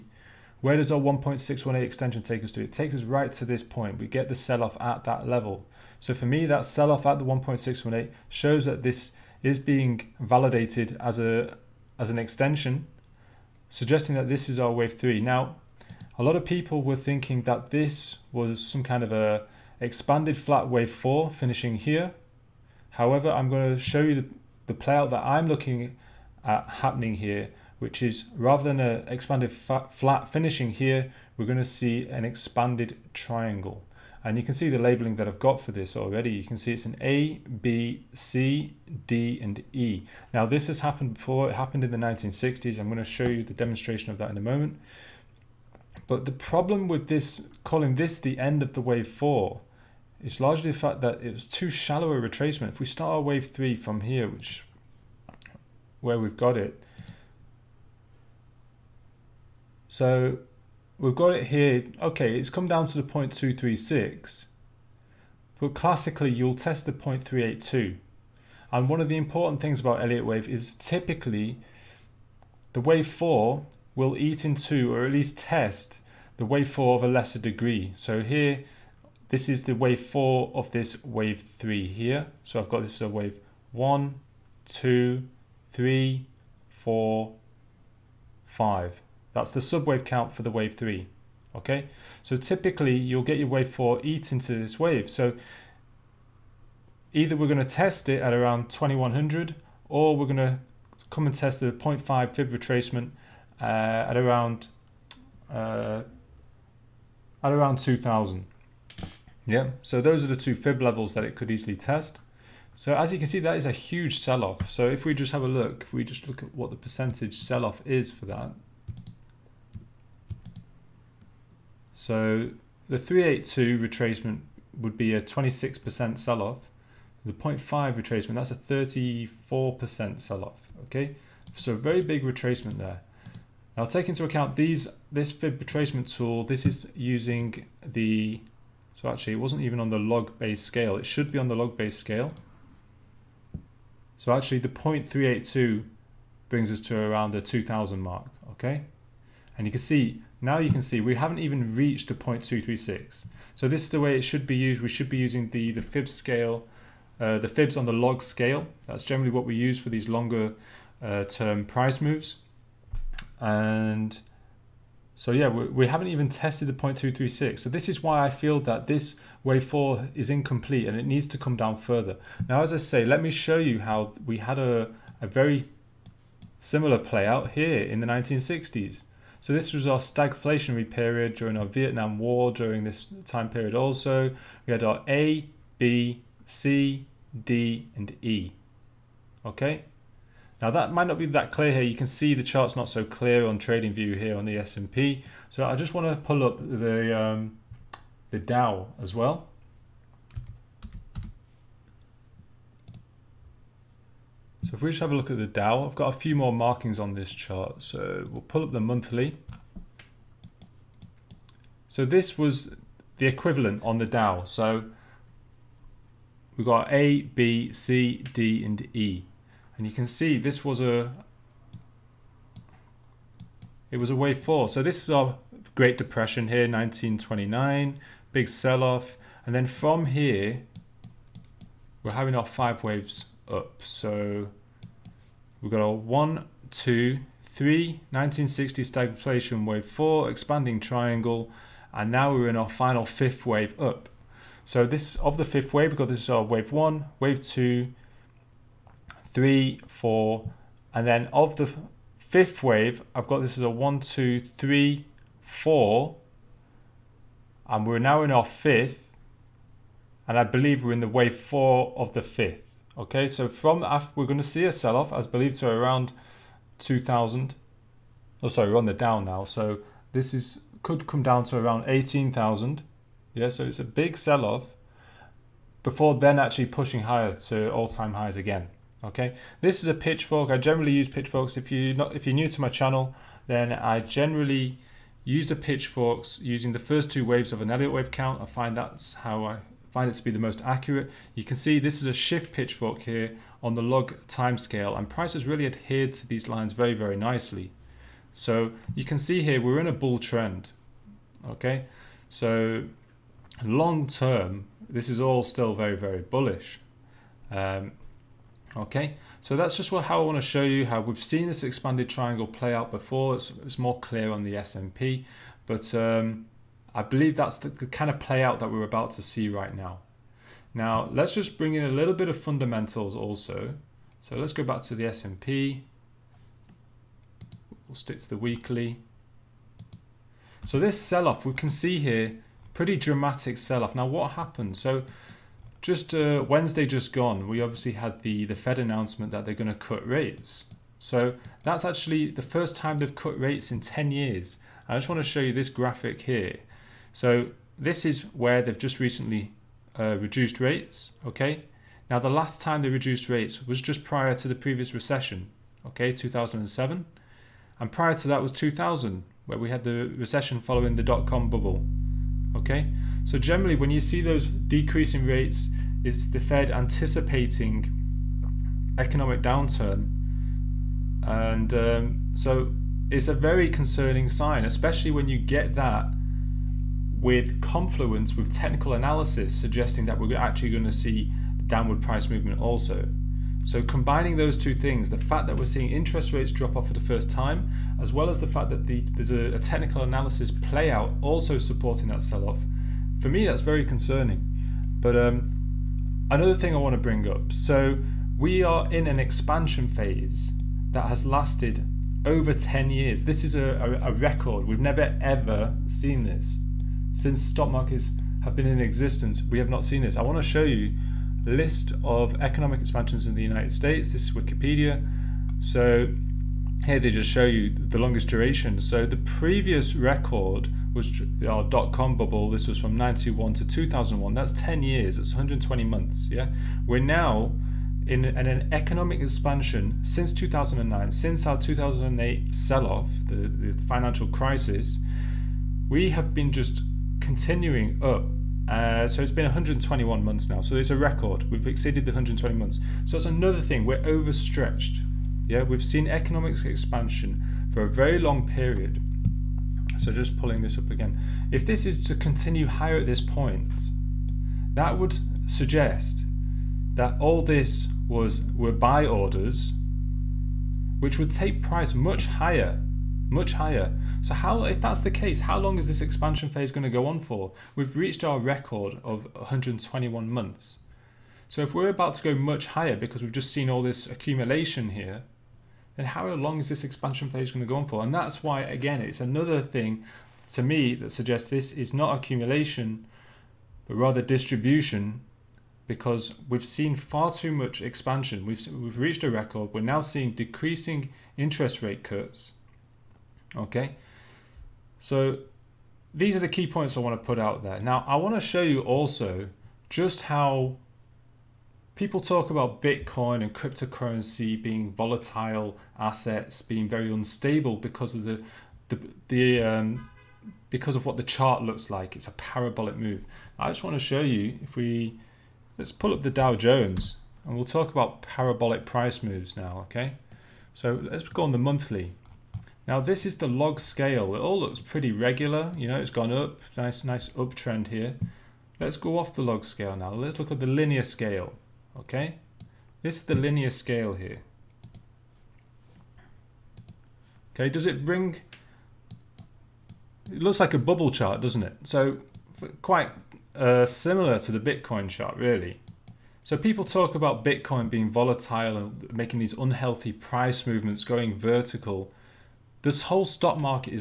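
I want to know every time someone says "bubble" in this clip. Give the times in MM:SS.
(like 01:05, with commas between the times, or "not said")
06:01, 07:02, 09:00.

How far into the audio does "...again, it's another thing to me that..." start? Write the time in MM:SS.
07:58.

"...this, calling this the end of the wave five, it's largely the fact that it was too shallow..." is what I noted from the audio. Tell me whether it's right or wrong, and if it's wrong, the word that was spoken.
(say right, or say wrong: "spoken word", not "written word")
wrong: "four", not "five".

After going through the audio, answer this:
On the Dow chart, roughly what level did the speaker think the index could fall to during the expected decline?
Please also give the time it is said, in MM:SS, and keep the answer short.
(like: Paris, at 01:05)
18,000, at 04:31.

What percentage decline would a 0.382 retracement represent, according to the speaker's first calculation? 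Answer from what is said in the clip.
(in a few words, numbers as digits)
26%.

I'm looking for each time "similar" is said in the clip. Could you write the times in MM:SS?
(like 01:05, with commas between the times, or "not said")
02:56, 09:03.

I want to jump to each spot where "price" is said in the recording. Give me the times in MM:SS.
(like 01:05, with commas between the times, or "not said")
02:41, 04:55, 06:22, 07:41, 08:38, 09:10.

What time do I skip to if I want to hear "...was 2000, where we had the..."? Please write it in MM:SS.
05:58.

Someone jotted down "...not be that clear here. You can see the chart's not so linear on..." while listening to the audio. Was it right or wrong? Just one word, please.
wrong.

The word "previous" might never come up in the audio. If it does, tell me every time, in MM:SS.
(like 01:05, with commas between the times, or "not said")
05:54, 06:59.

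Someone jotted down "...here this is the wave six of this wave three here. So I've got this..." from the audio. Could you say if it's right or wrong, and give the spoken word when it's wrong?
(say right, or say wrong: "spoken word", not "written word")
wrong: "four", not "six".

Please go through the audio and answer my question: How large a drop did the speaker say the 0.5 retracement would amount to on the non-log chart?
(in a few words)
34%.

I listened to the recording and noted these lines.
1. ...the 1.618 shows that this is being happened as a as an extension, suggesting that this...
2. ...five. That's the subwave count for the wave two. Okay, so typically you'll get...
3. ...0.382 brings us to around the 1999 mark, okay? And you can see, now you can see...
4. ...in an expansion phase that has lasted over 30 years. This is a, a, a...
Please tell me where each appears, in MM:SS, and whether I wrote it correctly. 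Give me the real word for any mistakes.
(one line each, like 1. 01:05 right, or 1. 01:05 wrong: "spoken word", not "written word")
1. 00:07 wrong: "validated", not "happened"
2. 01:28 wrong: "three", not "two"
3. 02:24 wrong: "2000", not "1999"
4. 06:38 wrong: "10", not "30".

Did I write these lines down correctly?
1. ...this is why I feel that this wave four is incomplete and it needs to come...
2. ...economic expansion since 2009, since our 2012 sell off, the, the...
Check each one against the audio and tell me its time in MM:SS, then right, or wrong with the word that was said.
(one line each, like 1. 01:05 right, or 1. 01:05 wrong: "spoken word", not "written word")
1. 02:47 right
2. 07:08 wrong: "2008", not "2012".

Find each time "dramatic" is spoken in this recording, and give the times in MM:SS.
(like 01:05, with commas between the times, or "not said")
05:32.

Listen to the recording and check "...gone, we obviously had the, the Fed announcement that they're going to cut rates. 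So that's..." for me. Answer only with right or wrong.
right.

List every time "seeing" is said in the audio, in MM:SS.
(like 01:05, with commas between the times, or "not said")
06:25, 08:09.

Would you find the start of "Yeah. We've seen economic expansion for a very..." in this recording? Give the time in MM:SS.
07:25.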